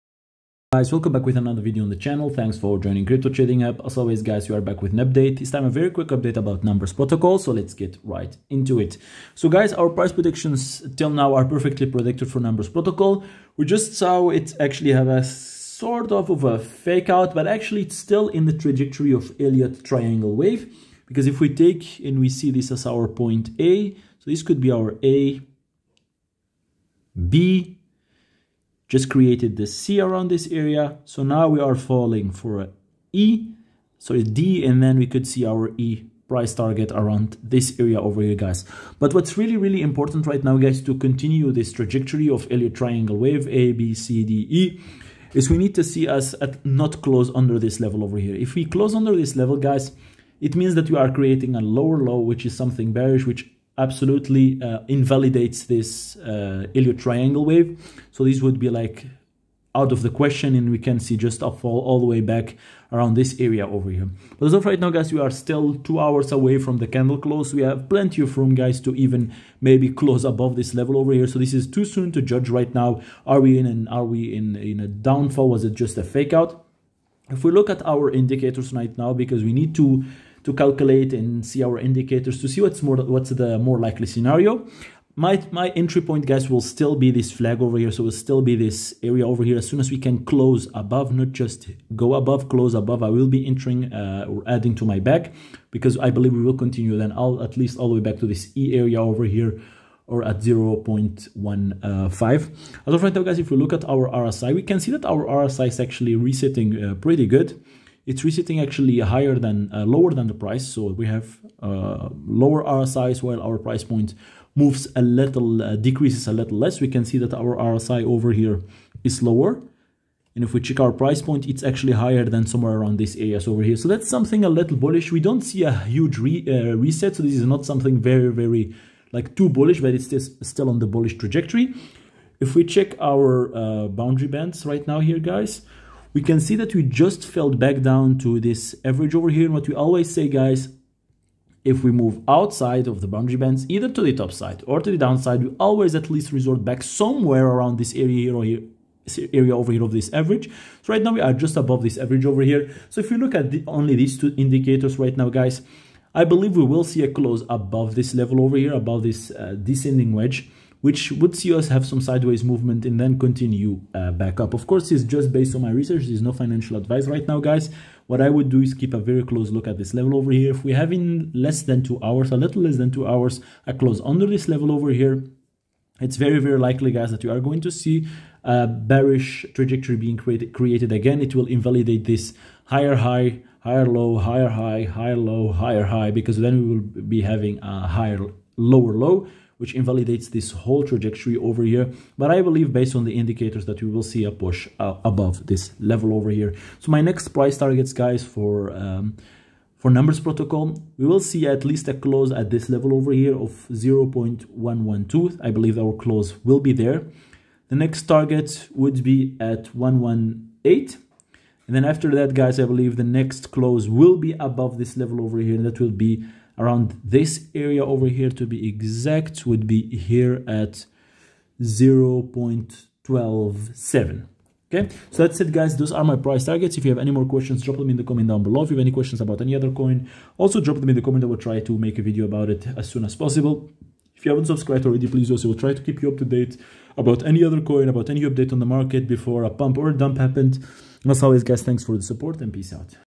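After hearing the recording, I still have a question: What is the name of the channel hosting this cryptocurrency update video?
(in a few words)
Crypto Trading Hub.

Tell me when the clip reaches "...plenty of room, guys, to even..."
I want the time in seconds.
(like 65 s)
67 s.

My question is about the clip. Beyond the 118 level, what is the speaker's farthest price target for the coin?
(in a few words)
0.127.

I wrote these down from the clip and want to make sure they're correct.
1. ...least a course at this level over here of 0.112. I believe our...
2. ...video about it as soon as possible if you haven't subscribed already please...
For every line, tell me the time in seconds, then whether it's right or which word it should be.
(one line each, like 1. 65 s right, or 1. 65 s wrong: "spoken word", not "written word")
1. 201 s wrong: "close", not "course"
2. 232 s right.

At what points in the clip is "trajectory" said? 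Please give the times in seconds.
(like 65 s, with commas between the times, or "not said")
18 s, 41 s, 131 s, 179 s, 190 s.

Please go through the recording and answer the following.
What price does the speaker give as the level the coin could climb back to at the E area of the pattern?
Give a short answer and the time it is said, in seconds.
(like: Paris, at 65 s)
0.15, at 100 s.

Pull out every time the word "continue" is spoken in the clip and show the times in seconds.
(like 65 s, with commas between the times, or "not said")
40 s, 96 s, 163 s.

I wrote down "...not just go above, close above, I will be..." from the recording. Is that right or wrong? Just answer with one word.
right.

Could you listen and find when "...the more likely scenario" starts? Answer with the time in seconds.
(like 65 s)
83 s.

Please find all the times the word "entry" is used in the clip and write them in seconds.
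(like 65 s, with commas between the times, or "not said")
85 s.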